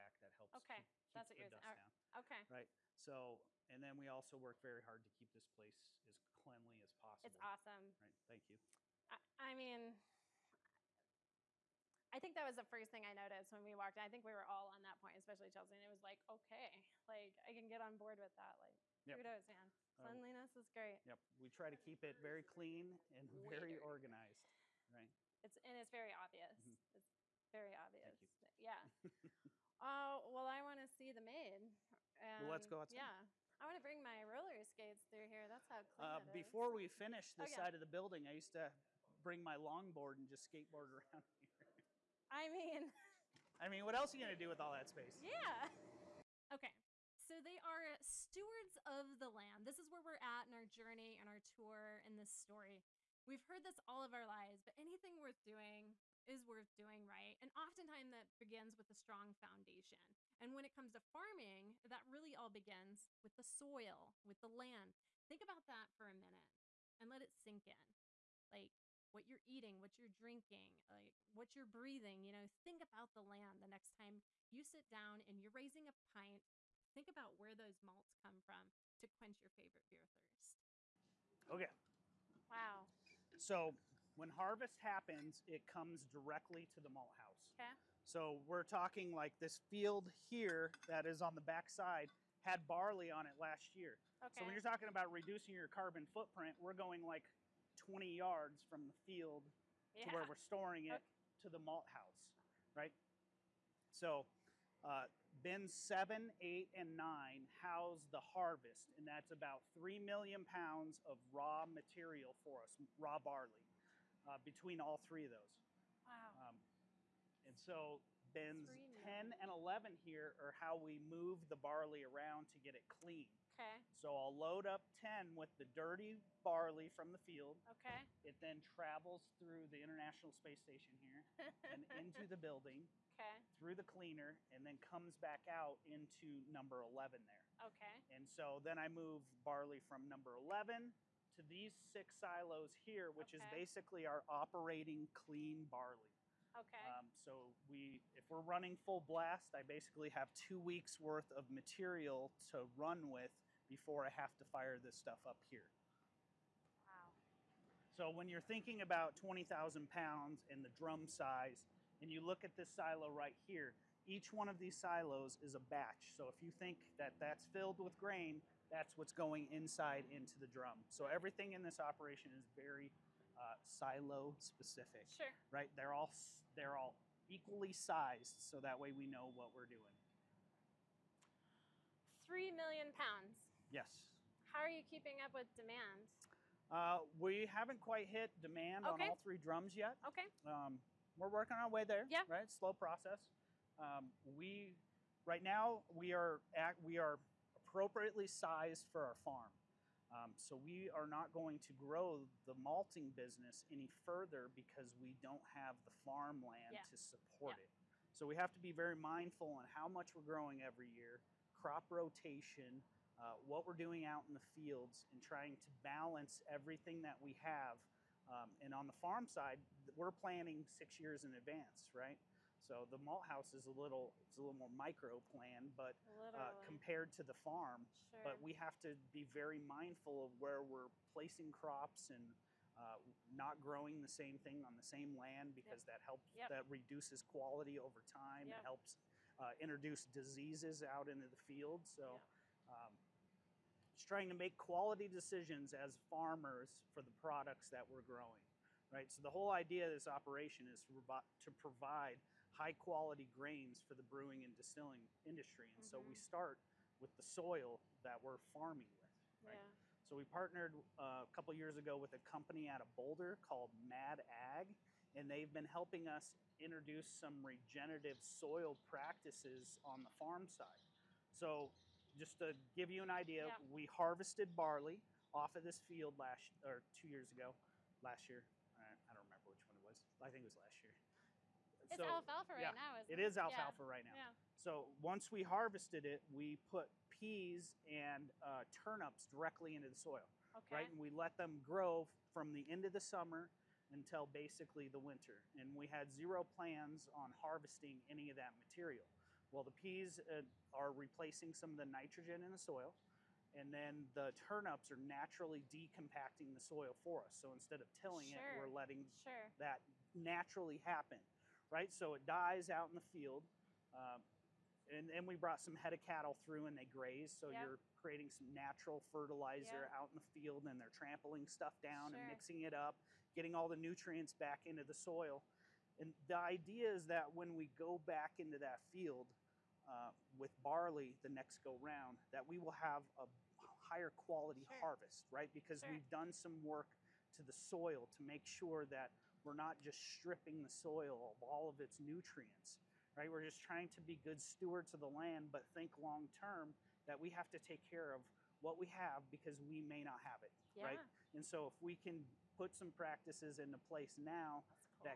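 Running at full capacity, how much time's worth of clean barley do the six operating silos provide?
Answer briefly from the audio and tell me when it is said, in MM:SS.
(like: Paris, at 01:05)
2 weeks, at 02:30.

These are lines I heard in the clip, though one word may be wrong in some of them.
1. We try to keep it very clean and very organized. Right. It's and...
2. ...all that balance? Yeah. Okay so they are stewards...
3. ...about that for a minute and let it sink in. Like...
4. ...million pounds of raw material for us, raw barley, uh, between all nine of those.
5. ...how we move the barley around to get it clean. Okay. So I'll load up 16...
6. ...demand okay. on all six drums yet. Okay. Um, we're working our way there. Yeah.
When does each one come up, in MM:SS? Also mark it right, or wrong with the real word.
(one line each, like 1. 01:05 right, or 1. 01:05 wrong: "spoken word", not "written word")
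1. 00:21 right
2. 00:44 wrong: "space", not "balance"
3. 01:05 right
4. 01:49 wrong: "three", not "nine"
5. 02:00 wrong: "10", not "16"
6. 03:08 wrong: "three", not "six".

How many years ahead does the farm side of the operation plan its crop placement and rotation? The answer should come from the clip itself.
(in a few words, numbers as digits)
6 years.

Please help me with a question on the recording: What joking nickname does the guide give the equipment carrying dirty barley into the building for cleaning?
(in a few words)
International Space Station.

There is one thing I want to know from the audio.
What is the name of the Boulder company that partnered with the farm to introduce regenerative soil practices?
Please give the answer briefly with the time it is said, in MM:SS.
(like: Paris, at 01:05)
Mad Ag, at 04:23.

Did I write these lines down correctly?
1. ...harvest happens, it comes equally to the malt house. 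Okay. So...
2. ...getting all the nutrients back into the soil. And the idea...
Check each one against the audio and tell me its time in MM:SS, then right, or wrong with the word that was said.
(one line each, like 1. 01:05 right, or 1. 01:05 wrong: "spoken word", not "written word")
1. 01:24 wrong: "directly", not "equally"
2. 05:23 right.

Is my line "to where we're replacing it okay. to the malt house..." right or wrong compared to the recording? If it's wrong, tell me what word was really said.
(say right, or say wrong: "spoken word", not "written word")
wrong: "storing", not "replacing".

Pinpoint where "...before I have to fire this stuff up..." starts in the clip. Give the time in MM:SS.
02:33.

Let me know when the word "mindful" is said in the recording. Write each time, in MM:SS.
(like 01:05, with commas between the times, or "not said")
03:28, 03:49.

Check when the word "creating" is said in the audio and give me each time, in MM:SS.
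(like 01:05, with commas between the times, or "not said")
05:17.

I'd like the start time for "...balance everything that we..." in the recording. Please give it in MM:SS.
03:35.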